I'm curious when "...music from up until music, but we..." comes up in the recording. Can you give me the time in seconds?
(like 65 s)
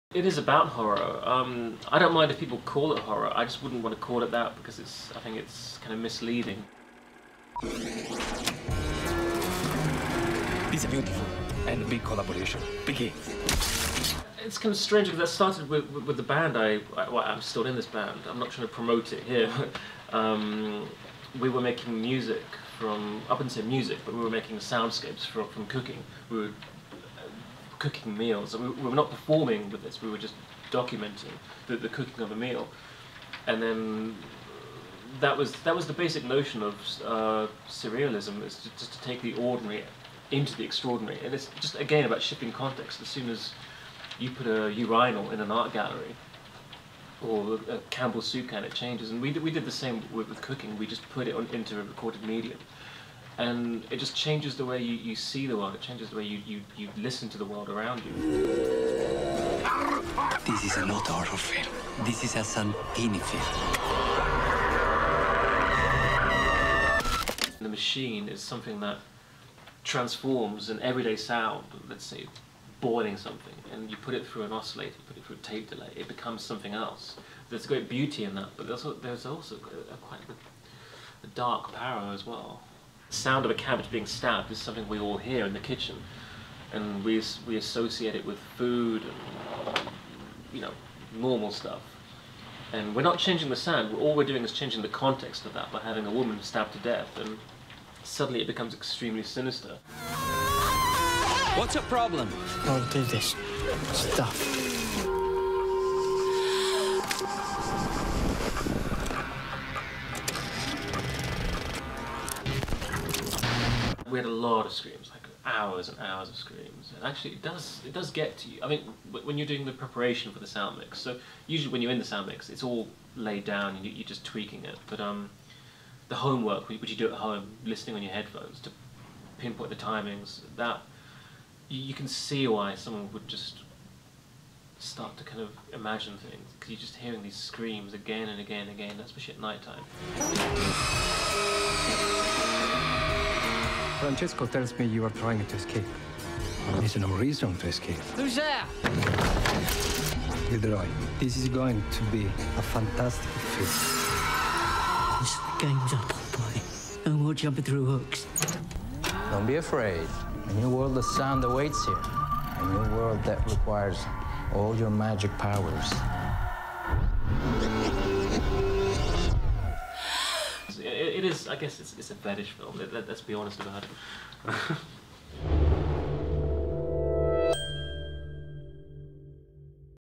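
22 s.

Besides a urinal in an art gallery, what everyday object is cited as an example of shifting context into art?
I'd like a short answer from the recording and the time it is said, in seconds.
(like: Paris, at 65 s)
Campbell soup can, at 47 s.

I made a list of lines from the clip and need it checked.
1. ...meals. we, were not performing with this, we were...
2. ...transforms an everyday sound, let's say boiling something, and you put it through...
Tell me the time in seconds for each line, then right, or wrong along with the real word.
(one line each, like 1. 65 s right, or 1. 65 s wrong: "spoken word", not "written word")
1. 28 s right
2. 69 s right.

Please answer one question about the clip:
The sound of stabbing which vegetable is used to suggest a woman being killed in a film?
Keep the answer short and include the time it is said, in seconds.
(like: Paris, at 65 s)
Cabbage, at 83 s.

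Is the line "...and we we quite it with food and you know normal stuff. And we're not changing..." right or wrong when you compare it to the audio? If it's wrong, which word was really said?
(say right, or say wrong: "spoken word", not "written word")
wrong: "associate", not "quite".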